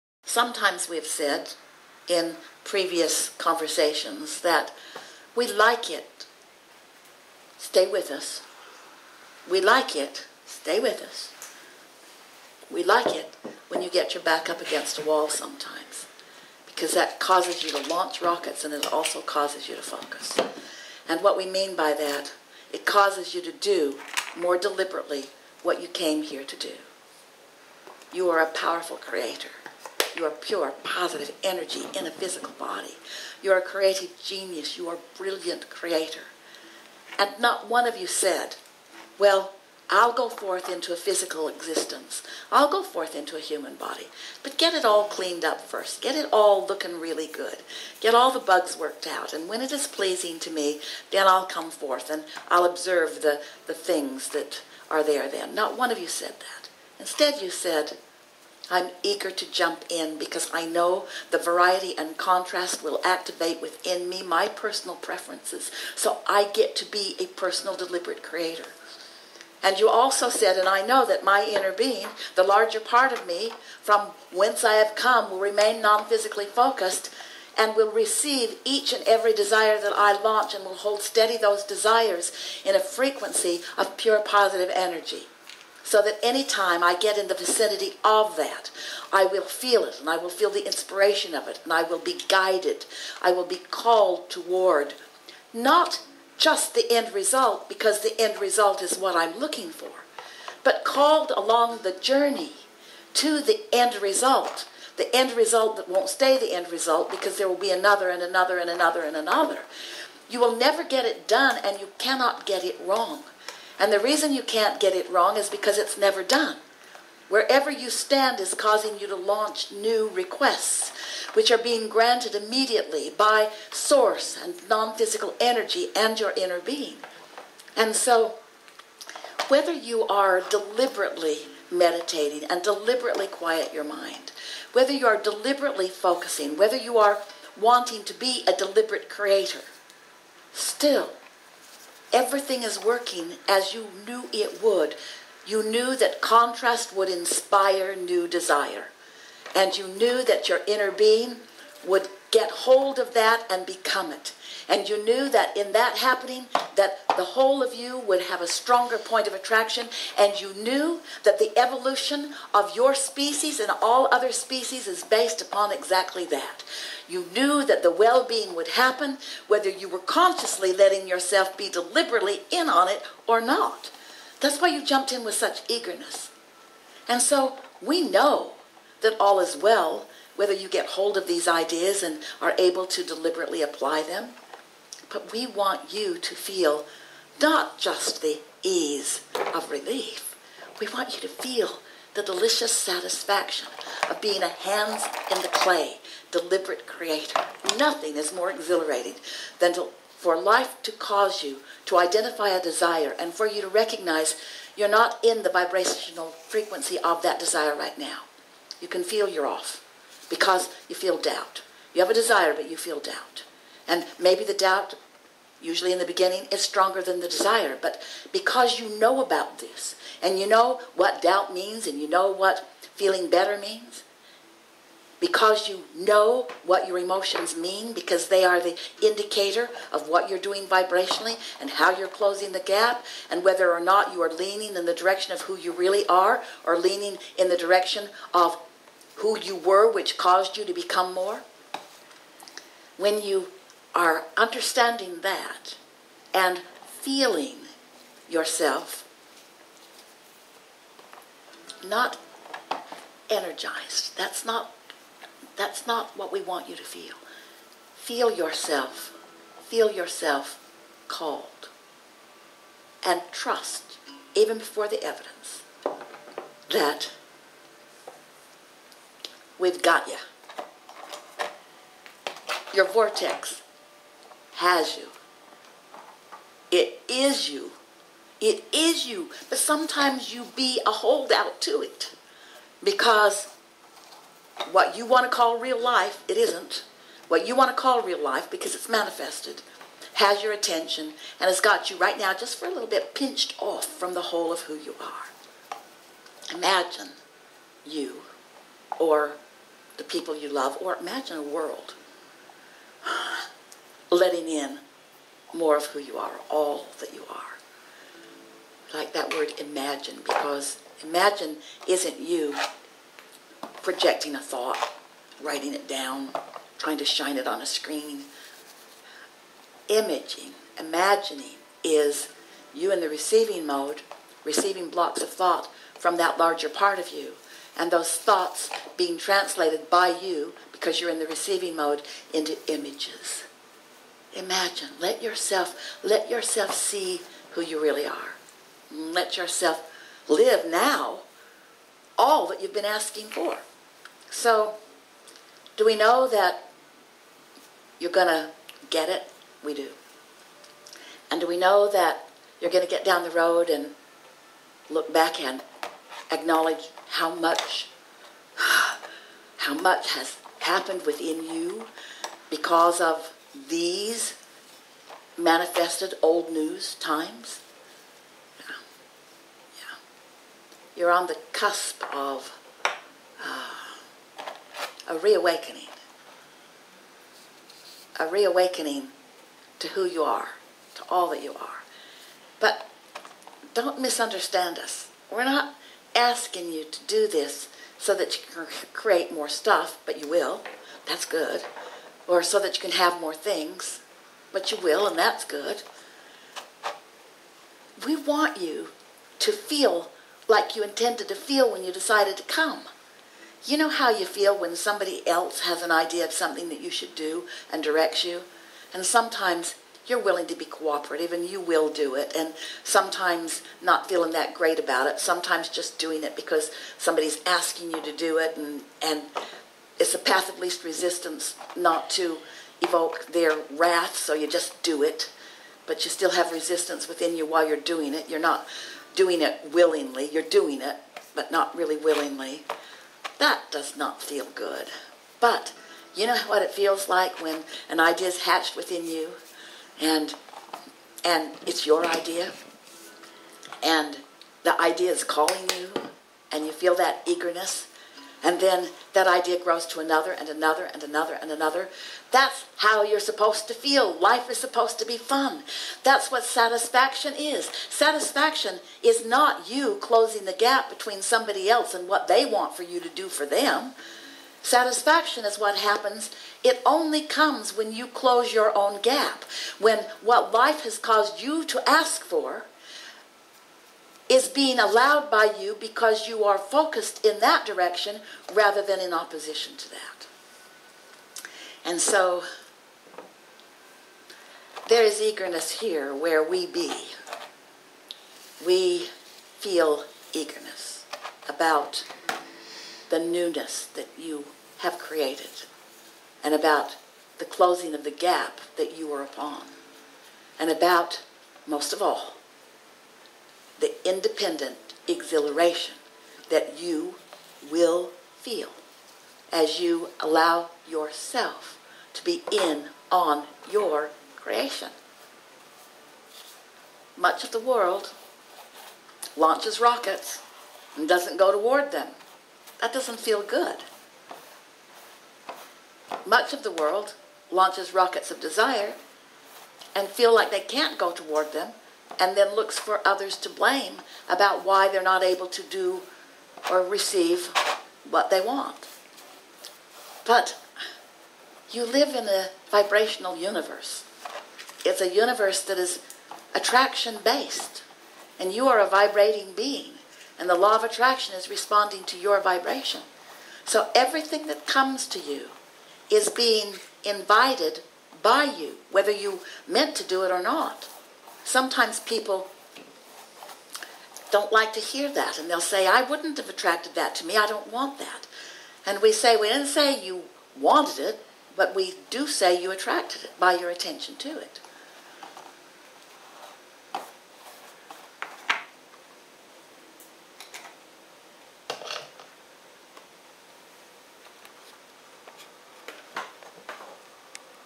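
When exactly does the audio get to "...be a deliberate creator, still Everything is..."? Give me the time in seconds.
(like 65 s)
138 s.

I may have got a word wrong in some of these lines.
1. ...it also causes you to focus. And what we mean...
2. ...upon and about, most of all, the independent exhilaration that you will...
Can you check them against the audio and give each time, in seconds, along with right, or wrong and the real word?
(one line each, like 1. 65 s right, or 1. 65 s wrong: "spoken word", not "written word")
1. 18 s right
2. 499 s right.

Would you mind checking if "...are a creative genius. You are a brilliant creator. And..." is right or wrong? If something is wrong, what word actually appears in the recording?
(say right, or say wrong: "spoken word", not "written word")
right.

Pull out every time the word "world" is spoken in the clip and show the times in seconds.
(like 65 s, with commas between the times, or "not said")
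301 s, 517 s, 526 s.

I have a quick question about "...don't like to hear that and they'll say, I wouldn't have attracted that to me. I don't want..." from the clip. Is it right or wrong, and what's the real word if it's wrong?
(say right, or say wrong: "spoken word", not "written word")
right.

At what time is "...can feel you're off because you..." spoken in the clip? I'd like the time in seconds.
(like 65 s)
208 s.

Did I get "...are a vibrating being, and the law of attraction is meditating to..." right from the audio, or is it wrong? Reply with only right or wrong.
wrong.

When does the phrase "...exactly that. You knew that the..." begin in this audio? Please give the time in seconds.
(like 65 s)
165 s.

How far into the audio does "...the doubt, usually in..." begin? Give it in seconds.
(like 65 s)
214 s.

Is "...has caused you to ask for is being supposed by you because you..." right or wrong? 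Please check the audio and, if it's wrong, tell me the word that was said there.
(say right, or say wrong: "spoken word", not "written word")
wrong: "allowed", not "supposed".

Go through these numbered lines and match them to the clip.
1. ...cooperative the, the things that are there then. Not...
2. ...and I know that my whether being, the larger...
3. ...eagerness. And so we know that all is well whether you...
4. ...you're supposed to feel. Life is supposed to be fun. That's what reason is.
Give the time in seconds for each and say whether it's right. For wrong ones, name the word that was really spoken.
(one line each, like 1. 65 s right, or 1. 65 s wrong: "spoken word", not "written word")
1. 52 s wrong: "observe", not "cooperative"
2. 70 s wrong: "inner", not "whether"
3. 175 s right
4. 453 s wrong: "satisfaction", not "reason".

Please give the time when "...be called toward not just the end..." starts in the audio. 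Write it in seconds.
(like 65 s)
93 s.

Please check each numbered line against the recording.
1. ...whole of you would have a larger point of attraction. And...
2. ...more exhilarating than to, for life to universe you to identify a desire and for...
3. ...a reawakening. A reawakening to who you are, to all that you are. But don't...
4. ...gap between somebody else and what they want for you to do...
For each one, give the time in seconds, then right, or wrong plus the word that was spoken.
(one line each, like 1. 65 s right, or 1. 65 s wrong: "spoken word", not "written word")
1. 157 s wrong: "stronger", not "larger"
2. 198 s wrong: "cause", not "universe"
3. 375 s right
4. 460 s right.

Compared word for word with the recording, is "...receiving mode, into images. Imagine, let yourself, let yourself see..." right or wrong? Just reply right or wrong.
right.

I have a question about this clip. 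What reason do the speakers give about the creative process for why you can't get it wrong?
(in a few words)
it's never done.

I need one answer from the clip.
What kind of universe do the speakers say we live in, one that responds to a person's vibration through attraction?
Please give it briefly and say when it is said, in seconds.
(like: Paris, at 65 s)
vibrational universe, at 542 s.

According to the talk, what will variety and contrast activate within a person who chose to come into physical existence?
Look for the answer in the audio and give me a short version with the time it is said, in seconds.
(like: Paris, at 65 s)
personal preferences, at 64 s.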